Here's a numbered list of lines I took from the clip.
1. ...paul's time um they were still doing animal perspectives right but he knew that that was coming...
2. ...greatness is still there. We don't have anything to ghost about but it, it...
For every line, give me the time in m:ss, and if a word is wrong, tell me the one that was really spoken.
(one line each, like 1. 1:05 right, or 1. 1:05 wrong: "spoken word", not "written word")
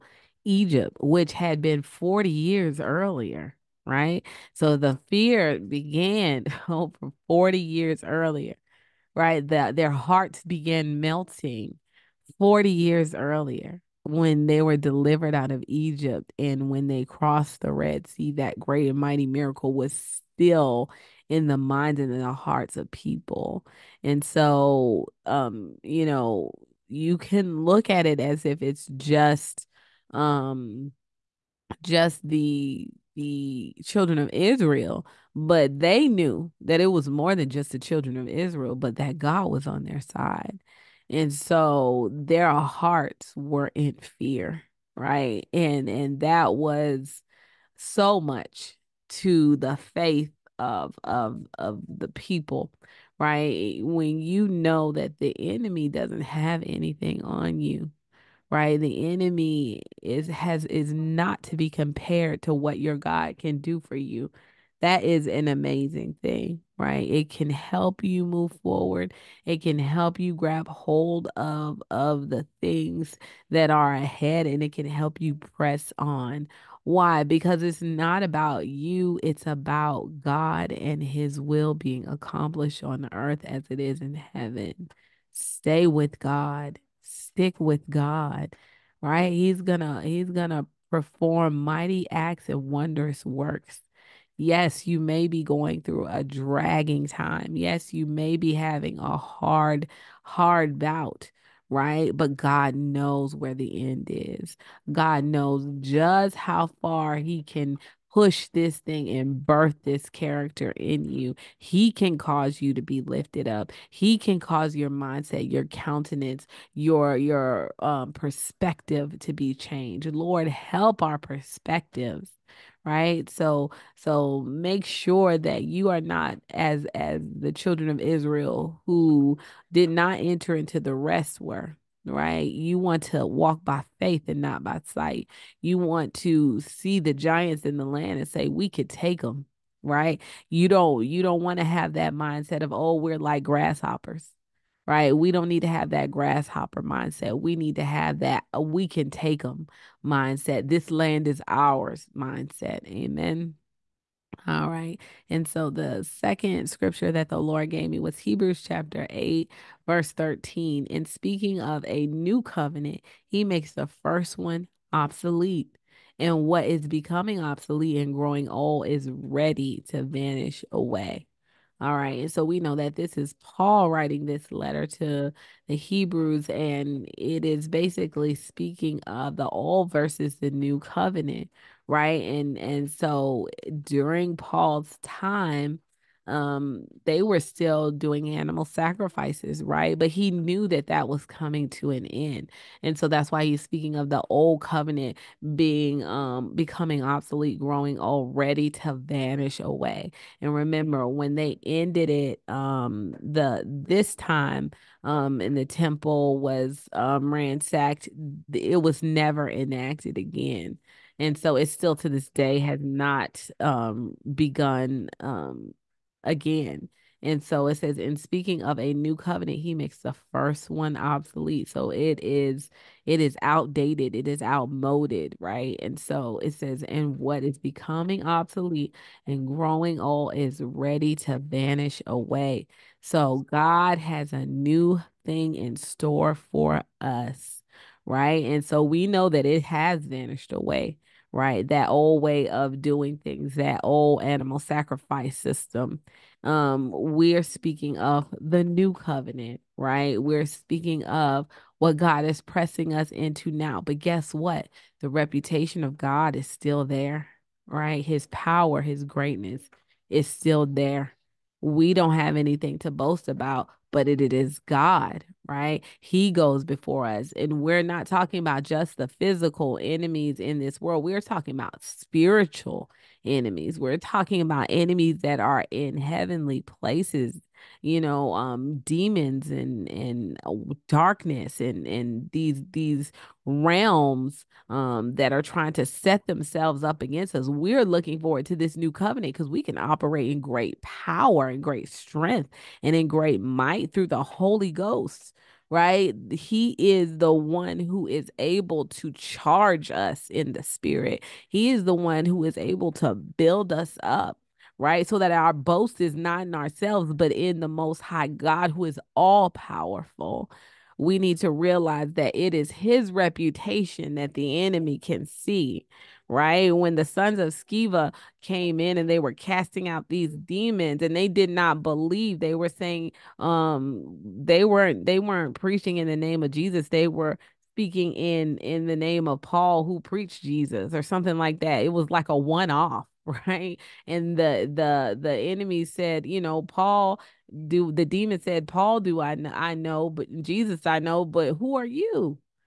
1. 3:04 wrong: "sacrifices", not "perspectives"
2. 4:19 wrong: "boast", not "ghost".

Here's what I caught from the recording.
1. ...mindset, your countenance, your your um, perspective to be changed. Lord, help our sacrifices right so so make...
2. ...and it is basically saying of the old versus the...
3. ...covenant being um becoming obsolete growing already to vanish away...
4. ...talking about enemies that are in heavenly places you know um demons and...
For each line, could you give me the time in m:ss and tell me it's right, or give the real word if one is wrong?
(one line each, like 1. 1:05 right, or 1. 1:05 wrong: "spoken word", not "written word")
1. 1:54 wrong: "perspectives", not "sacrifices"
2. 2:56 wrong: "speaking", not "saying"
3. 3:14 right
4. 4:33 right.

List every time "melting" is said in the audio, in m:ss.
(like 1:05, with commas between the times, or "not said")
0:11.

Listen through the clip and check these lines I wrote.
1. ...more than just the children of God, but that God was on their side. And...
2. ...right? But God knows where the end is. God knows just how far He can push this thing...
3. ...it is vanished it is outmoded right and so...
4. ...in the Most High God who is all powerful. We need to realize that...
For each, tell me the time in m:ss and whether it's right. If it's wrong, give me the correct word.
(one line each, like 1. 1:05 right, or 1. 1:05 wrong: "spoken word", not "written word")
1. 0:37 wrong: "Israel", not "God"
2. 1:41 right
3. 3:43 wrong: "outdated", not "vanished"
4. 5:07 right.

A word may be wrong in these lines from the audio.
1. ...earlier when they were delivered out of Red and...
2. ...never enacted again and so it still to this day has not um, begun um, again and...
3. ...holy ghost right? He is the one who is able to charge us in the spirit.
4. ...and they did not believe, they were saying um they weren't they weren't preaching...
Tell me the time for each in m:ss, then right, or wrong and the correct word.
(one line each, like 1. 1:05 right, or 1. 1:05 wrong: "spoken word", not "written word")
1. 0:13 wrong: "Egypt", not "Red"
2. 3:29 right
3. 4:54 right
4. 5:21 right.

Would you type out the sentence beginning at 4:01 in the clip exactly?
That old way of doing things, that old animal sacrifice system.